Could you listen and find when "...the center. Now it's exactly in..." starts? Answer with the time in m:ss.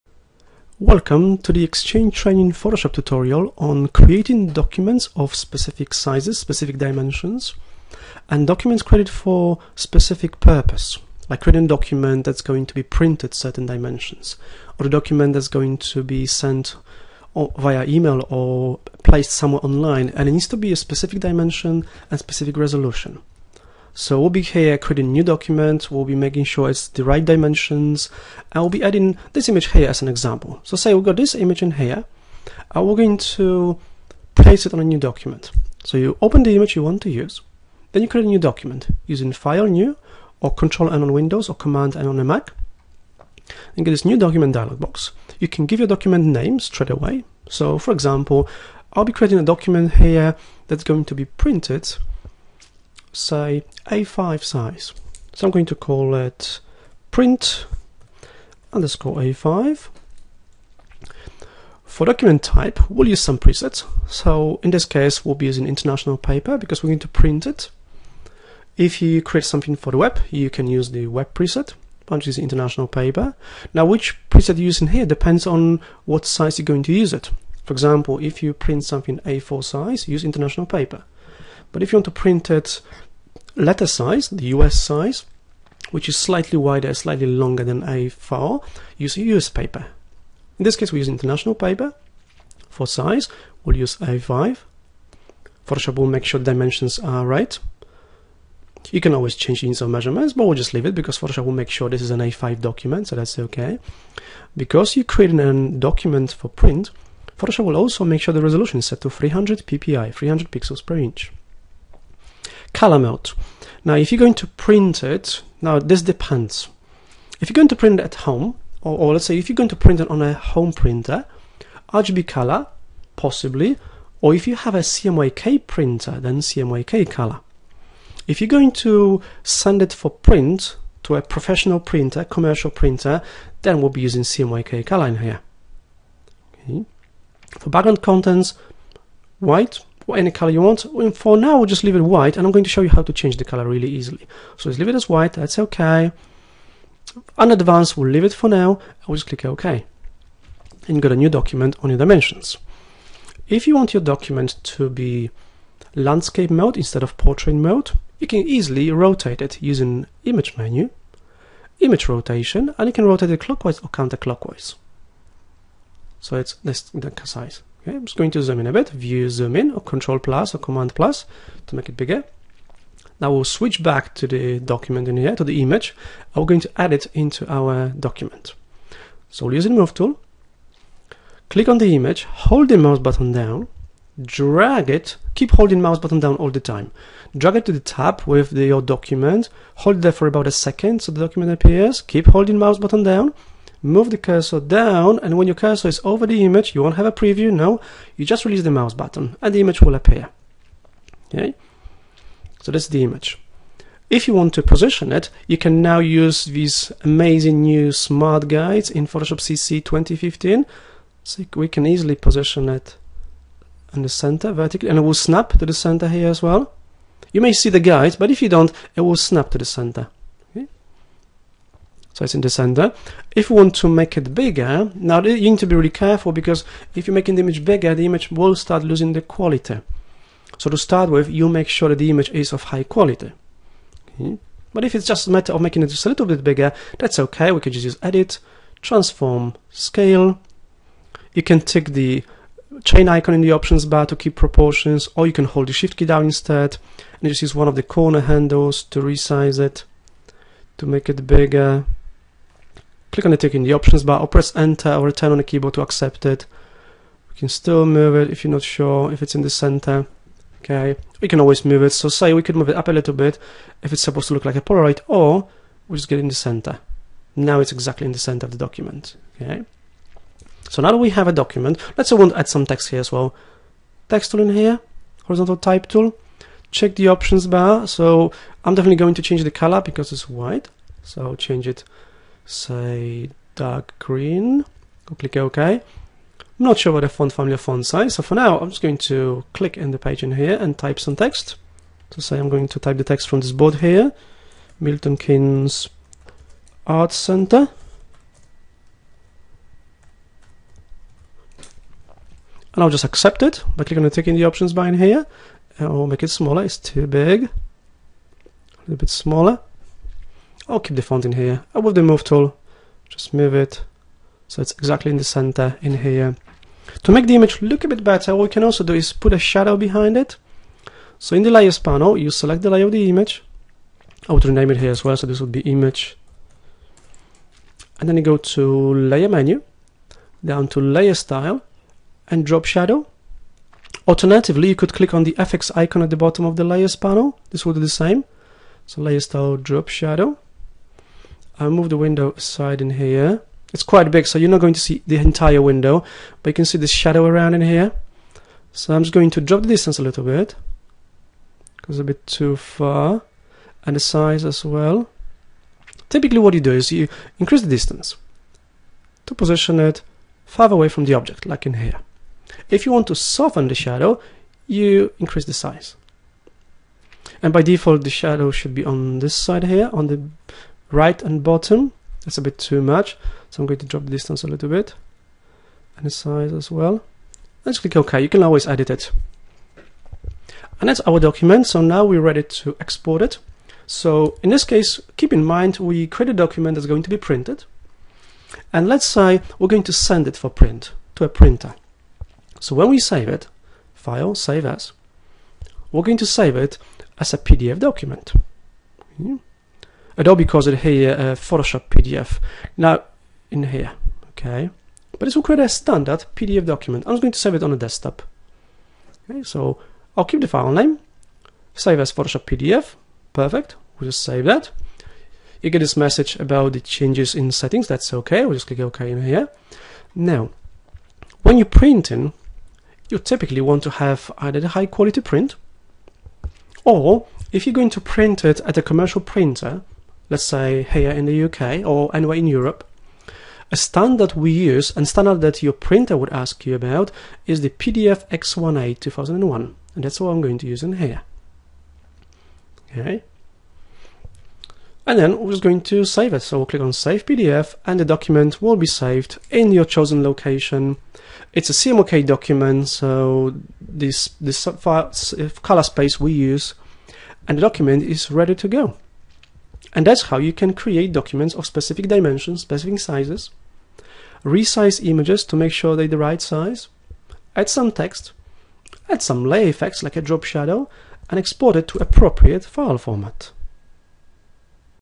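4:26.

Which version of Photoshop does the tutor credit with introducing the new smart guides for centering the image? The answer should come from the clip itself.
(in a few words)
Photoshop CC 2015.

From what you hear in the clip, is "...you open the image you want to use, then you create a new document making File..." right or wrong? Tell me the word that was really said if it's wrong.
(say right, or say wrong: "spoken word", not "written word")
wrong: "using", not "making".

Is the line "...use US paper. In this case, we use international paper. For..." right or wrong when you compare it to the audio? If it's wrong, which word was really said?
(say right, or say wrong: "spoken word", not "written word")
right.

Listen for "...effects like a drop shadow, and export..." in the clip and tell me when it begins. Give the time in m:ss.
7:49.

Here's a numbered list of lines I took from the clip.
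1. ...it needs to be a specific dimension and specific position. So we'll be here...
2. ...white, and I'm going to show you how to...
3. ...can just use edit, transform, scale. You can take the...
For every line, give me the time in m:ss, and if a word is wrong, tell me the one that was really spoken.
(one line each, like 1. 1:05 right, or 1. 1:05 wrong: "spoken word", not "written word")
1. 0:20 wrong: "resolution", not "position"
2. 2:22 right
3. 3:57 right.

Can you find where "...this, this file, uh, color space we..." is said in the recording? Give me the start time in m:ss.
7:33.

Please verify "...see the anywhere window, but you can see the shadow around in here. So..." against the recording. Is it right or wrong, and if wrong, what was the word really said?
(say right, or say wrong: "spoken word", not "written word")
wrong: "entire", not "anywhere".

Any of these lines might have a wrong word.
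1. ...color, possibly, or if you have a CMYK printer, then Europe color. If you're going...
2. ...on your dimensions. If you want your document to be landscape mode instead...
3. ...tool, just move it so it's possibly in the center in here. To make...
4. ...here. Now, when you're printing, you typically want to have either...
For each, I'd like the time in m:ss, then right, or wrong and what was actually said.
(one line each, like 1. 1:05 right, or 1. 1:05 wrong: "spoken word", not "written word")
1. 2:02 wrong: "CMYK", not "Europe"
2. 2:31 right
3. 5:12 wrong: "exactly", not "possibly"
4. 6:59 right.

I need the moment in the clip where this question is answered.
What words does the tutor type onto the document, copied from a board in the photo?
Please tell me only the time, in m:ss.
4:54.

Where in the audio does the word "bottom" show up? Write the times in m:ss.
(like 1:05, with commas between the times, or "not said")
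5:36, 6:11.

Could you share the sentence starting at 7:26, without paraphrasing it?
So we'll click on Save PDF and the document will be saved in your chosen location.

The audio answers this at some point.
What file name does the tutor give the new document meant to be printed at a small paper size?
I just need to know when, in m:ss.
0:57.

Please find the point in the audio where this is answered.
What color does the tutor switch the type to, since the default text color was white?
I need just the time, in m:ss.
4:43.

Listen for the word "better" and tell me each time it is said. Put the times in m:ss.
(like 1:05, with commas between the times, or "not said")
5:18.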